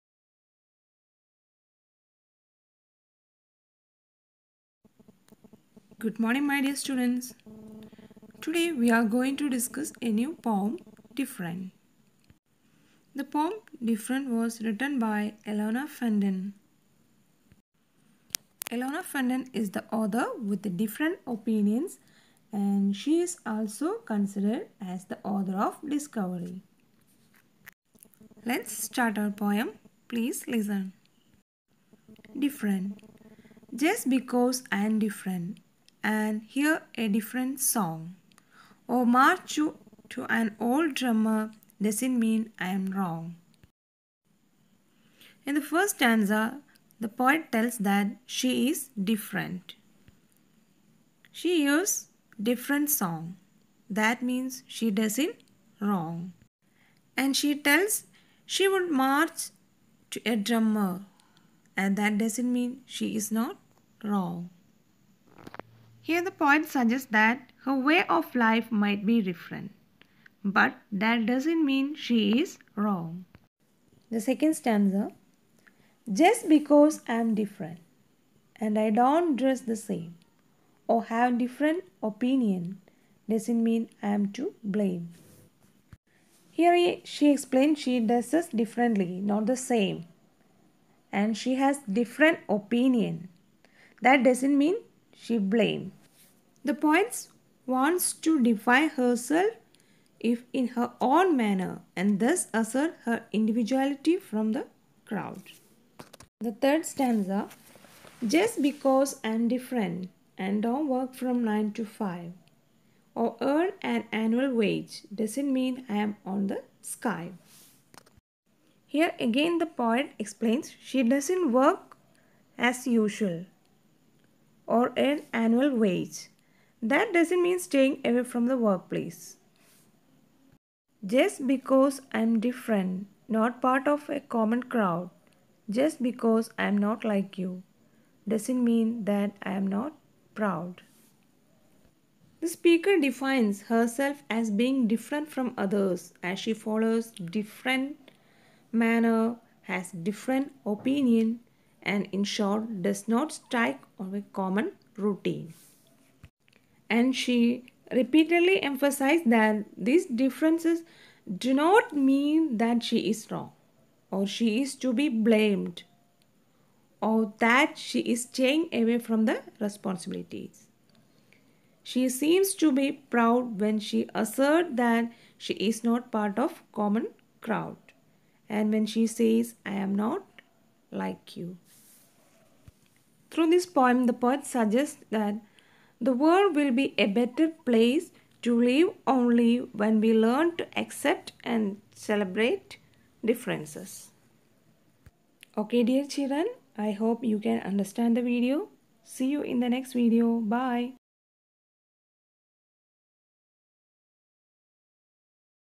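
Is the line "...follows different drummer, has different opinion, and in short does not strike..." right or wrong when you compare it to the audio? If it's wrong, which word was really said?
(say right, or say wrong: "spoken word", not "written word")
wrong: "manner", not "drummer".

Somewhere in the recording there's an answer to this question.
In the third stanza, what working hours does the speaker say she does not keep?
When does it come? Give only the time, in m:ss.
1:51.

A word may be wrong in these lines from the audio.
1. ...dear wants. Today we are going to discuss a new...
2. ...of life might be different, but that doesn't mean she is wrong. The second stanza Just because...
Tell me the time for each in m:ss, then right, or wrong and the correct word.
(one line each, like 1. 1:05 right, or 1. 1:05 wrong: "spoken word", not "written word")
1. 0:06 wrong: "students", not "wants"
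2. 1:08 right.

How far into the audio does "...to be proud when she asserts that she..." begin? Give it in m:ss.
2:52.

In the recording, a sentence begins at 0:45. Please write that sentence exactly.
In the first stanza, the poet tells that she is different.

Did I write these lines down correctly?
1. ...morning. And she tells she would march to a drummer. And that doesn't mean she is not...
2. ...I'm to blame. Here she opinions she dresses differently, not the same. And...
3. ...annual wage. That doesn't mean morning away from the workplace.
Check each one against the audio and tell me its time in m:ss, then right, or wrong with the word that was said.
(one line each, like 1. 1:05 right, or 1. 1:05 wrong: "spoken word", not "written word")
1. 0:55 wrong: "wrong", not "morning"
2. 1:24 wrong: "explains", not "opinions"
3. 2:05 wrong: "staying", not "morning".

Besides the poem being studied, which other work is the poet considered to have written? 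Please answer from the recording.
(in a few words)
Discovery.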